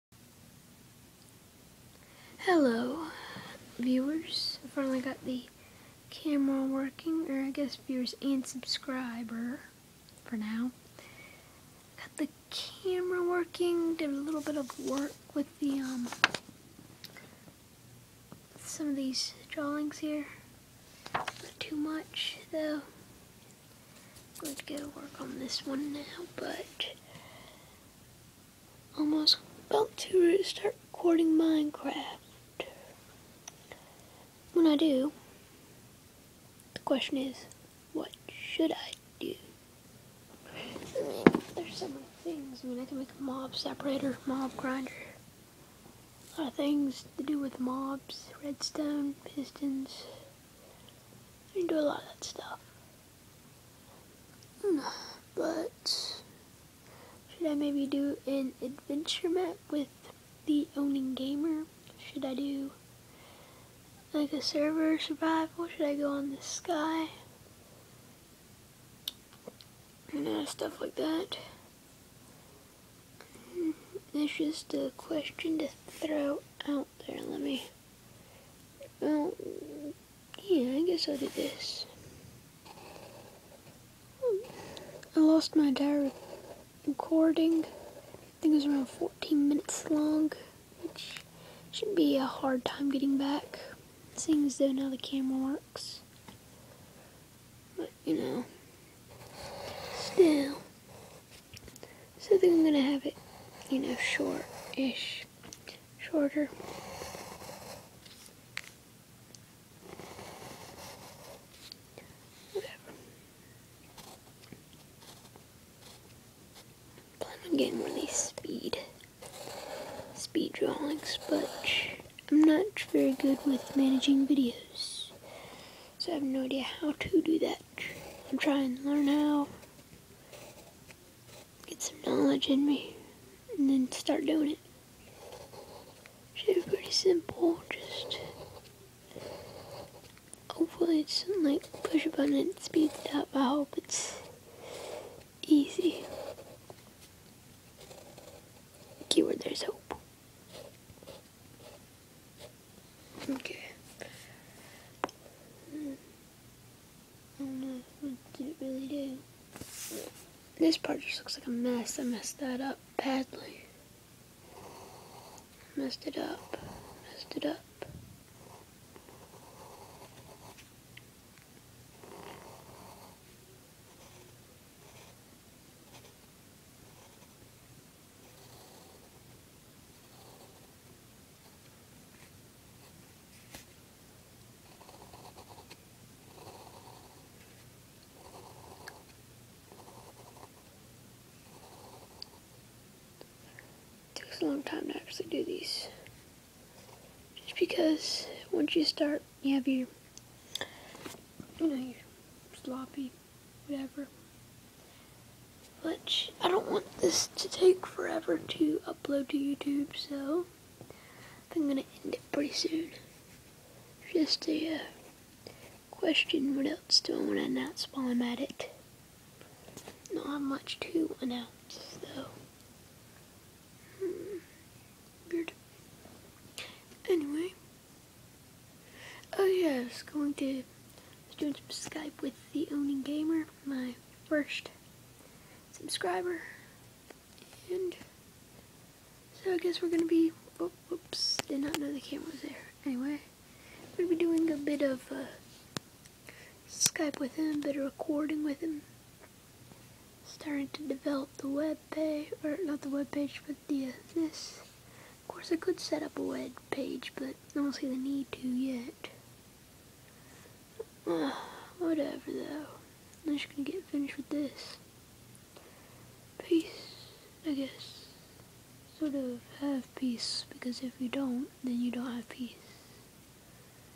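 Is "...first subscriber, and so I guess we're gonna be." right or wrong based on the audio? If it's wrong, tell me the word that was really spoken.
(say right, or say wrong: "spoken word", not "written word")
right.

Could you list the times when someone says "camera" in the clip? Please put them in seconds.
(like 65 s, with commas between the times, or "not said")
6 s, 12 s, 94 s, 241 s.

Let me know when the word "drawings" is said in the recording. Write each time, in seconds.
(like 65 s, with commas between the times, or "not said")
19 s, 120 s.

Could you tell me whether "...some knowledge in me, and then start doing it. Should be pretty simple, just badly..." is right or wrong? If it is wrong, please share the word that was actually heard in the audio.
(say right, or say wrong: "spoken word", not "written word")
wrong: "hopefully", not "badly".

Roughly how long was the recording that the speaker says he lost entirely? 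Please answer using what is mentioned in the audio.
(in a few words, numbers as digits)
14 minutes.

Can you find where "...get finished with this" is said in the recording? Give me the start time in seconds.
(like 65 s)
263 s.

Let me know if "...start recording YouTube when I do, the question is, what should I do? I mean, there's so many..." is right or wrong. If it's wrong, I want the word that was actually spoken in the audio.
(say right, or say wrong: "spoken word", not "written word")
wrong: "Minecraft", not "YouTube".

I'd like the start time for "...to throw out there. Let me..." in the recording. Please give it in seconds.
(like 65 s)
75 s.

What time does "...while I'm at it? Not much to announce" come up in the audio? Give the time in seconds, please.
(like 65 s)
217 s.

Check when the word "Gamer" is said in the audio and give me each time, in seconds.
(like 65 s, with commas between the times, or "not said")
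61 s, 233 s.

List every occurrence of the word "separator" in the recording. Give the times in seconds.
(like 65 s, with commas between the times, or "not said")
43 s.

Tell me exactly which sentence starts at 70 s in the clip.
You uh, know, stuff like that.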